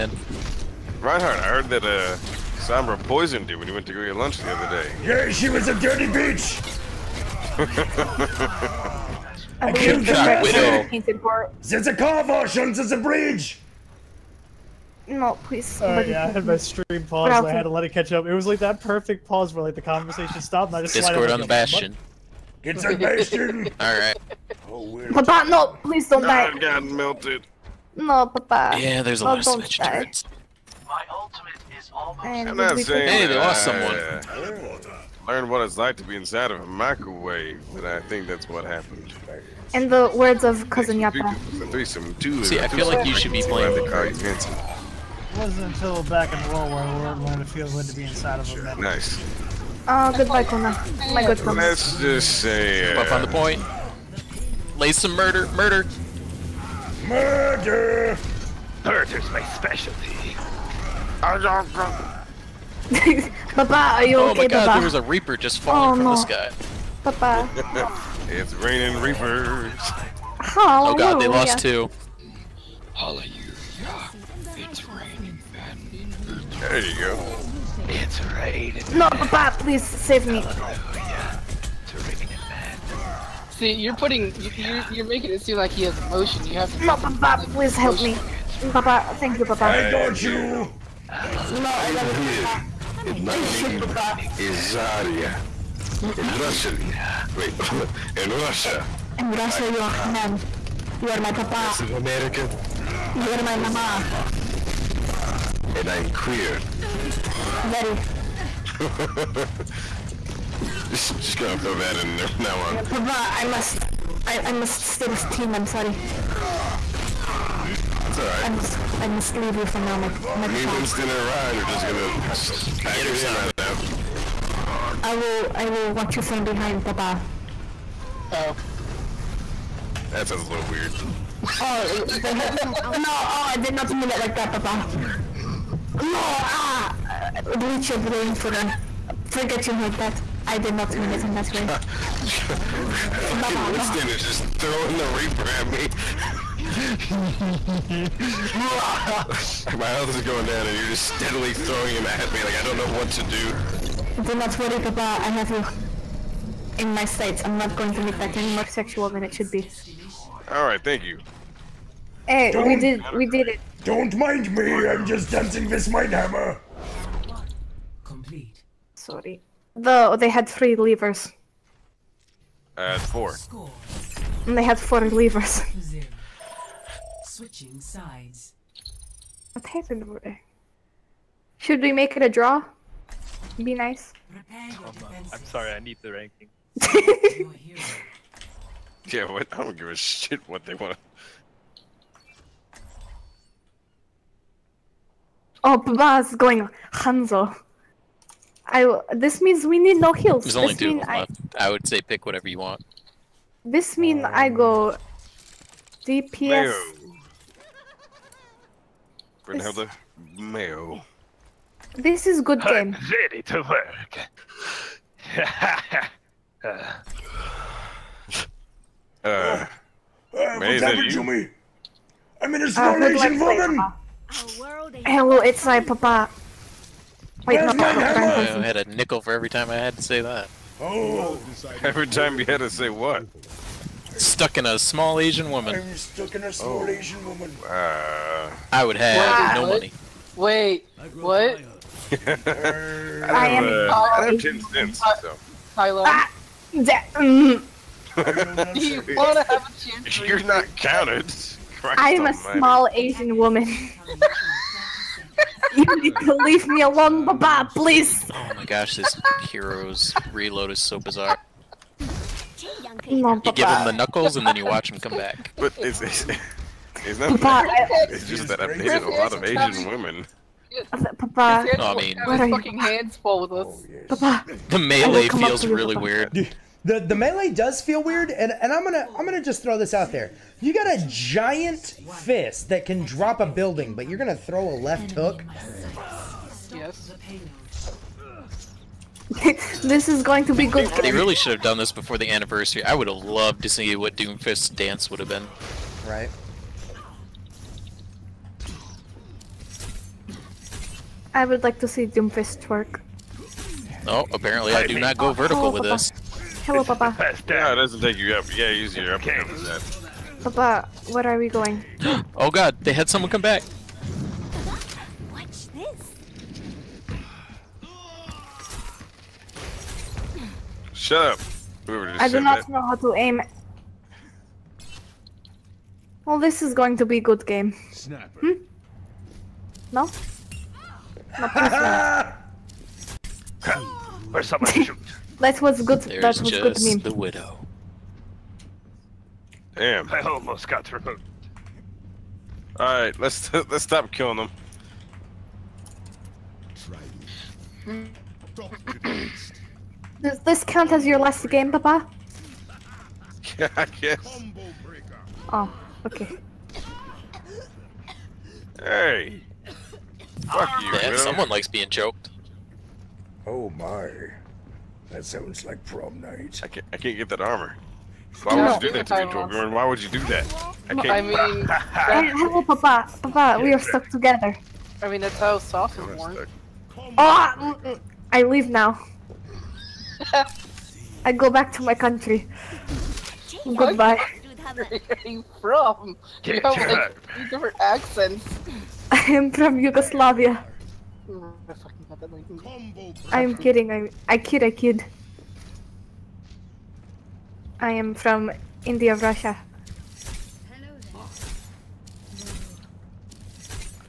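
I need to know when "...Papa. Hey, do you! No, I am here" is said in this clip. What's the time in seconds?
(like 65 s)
89 s.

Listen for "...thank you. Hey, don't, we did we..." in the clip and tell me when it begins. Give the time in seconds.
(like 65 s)
160 s.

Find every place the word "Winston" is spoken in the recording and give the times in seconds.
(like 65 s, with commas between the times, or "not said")
120 s, 143 s.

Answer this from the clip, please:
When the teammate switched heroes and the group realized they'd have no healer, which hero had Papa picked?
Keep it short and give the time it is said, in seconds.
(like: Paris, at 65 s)
Hanzo, at 195 s.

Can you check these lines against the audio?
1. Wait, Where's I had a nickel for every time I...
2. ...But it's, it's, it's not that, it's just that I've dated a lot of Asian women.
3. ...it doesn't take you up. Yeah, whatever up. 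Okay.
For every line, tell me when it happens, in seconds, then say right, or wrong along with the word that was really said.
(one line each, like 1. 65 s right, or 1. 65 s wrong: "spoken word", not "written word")
1. 227 s right
2. 265 s right
3. 307 s wrong: "easier", not "whatever".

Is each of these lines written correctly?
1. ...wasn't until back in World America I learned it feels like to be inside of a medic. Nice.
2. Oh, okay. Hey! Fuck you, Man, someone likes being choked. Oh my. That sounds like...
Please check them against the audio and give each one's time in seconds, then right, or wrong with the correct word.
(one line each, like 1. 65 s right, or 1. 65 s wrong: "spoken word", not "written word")
1. 45 s wrong: "War", not "America"
2. 355 s right.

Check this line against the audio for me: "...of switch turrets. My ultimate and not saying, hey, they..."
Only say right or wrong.
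right.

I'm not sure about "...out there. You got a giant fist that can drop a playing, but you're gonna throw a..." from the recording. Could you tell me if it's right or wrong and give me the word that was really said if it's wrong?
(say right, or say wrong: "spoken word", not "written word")
wrong: "building", not "playing".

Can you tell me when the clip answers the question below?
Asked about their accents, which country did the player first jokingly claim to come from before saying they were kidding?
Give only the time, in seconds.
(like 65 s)
389 s.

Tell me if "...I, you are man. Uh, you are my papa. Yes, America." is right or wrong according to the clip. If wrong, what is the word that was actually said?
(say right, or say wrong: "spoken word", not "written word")
right.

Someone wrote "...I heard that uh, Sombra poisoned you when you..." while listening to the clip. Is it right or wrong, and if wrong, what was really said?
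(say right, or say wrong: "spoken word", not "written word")
right.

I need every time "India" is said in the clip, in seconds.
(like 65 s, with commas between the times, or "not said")
398 s.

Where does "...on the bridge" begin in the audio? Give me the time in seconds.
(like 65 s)
12 s.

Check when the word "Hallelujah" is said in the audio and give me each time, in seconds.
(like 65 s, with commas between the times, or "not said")
72 s, 80 s.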